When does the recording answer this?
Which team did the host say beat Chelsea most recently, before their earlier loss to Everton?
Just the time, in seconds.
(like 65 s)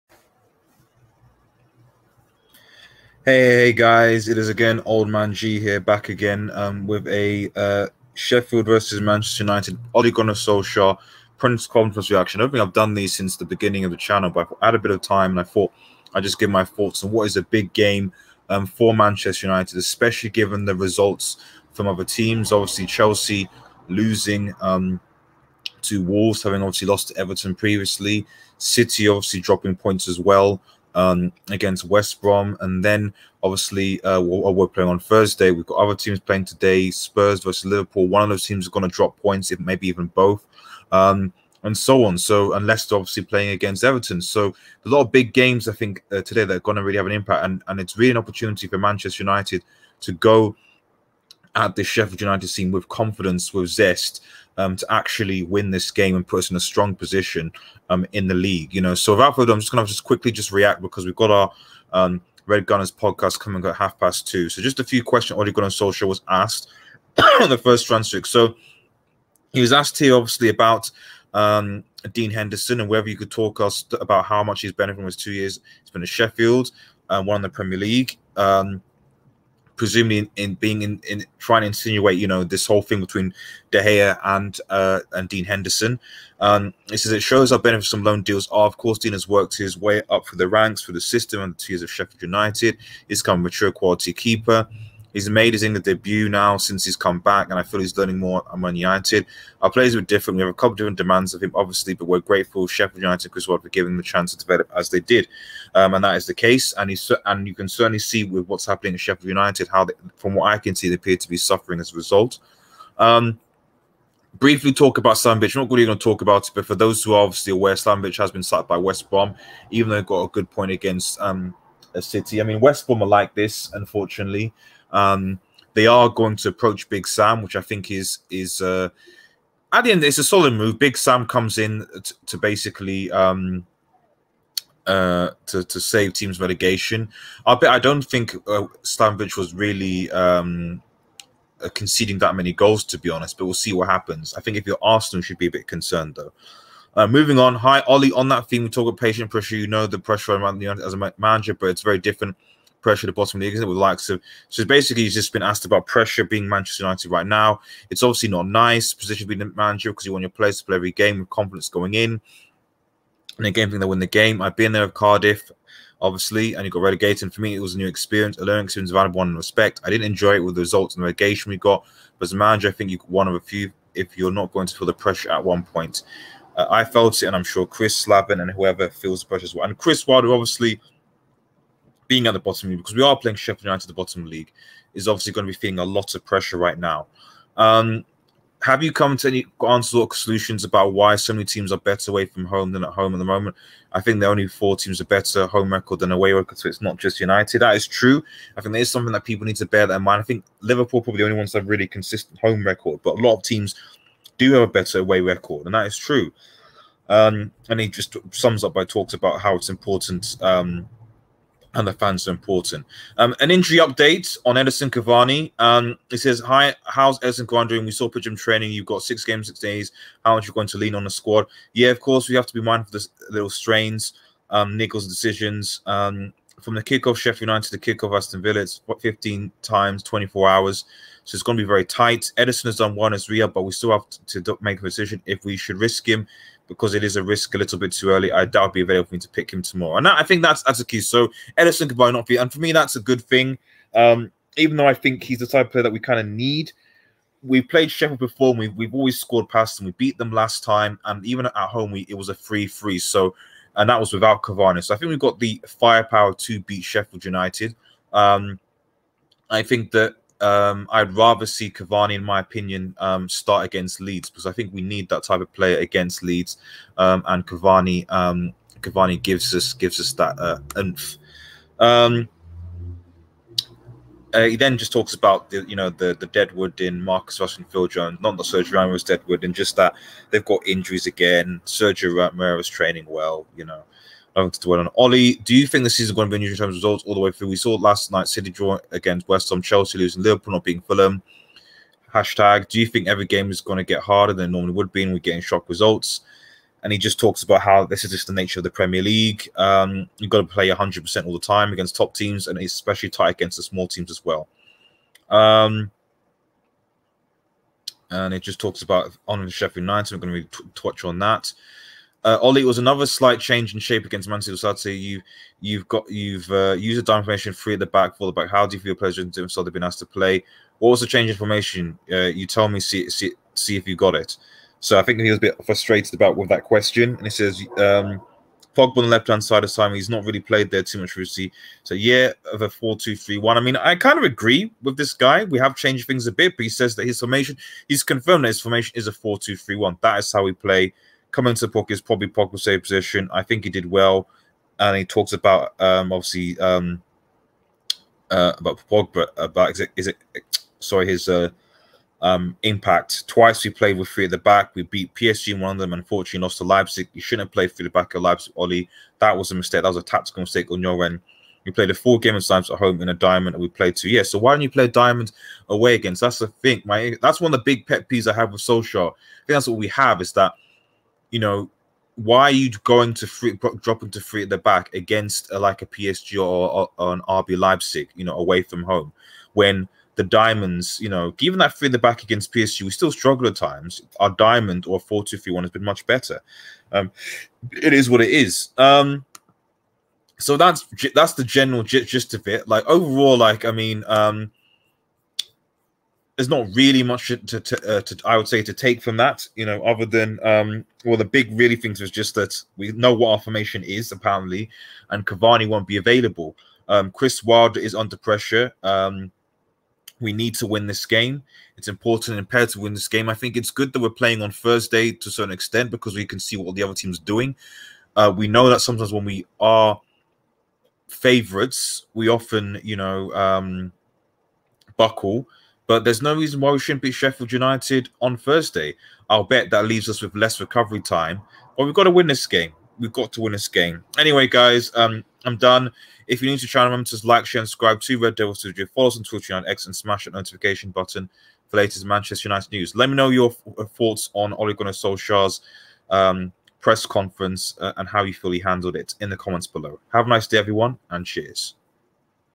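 26 s.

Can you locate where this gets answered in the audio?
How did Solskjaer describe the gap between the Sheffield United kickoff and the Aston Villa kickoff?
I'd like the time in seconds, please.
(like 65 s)
229 s.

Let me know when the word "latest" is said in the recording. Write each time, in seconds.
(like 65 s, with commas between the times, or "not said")
441 s.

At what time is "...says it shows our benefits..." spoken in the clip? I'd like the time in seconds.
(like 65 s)
86 s.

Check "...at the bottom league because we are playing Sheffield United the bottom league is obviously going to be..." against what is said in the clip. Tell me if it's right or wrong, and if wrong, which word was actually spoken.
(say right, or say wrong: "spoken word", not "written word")
right.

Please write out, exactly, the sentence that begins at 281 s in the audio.
Sergio Romero training well, you know to dwell on.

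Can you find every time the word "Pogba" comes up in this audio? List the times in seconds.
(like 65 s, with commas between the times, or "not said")
328 s, 342 s, 348 s.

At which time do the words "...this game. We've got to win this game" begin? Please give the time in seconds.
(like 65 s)
432 s.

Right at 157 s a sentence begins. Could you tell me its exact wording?
It's obviously not nice position being the manager because you want your players to play every game with confidence going in.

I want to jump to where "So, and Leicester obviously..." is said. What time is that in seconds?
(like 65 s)
42 s.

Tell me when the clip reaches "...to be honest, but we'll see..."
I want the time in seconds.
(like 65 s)
142 s.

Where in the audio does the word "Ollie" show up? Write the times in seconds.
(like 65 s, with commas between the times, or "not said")
147 s, 284 s, 312 s, 358 s.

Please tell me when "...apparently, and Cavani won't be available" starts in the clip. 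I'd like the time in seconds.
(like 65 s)
404 s.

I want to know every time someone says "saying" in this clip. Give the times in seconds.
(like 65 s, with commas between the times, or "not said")
not said.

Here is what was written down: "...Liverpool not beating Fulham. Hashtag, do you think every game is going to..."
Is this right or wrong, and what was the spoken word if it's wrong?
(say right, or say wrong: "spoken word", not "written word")
right.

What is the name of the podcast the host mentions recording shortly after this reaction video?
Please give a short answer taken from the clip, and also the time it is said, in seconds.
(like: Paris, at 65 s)
Red Gunners, at 62 s.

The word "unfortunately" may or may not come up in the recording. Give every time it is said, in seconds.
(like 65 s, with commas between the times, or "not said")
123 s, 355 s.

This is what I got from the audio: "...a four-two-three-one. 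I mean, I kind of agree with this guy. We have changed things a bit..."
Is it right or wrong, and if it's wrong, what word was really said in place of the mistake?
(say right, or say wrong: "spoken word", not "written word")
right.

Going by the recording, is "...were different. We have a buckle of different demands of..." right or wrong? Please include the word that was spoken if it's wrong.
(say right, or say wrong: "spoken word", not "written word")
wrong: "couple", not "buckle".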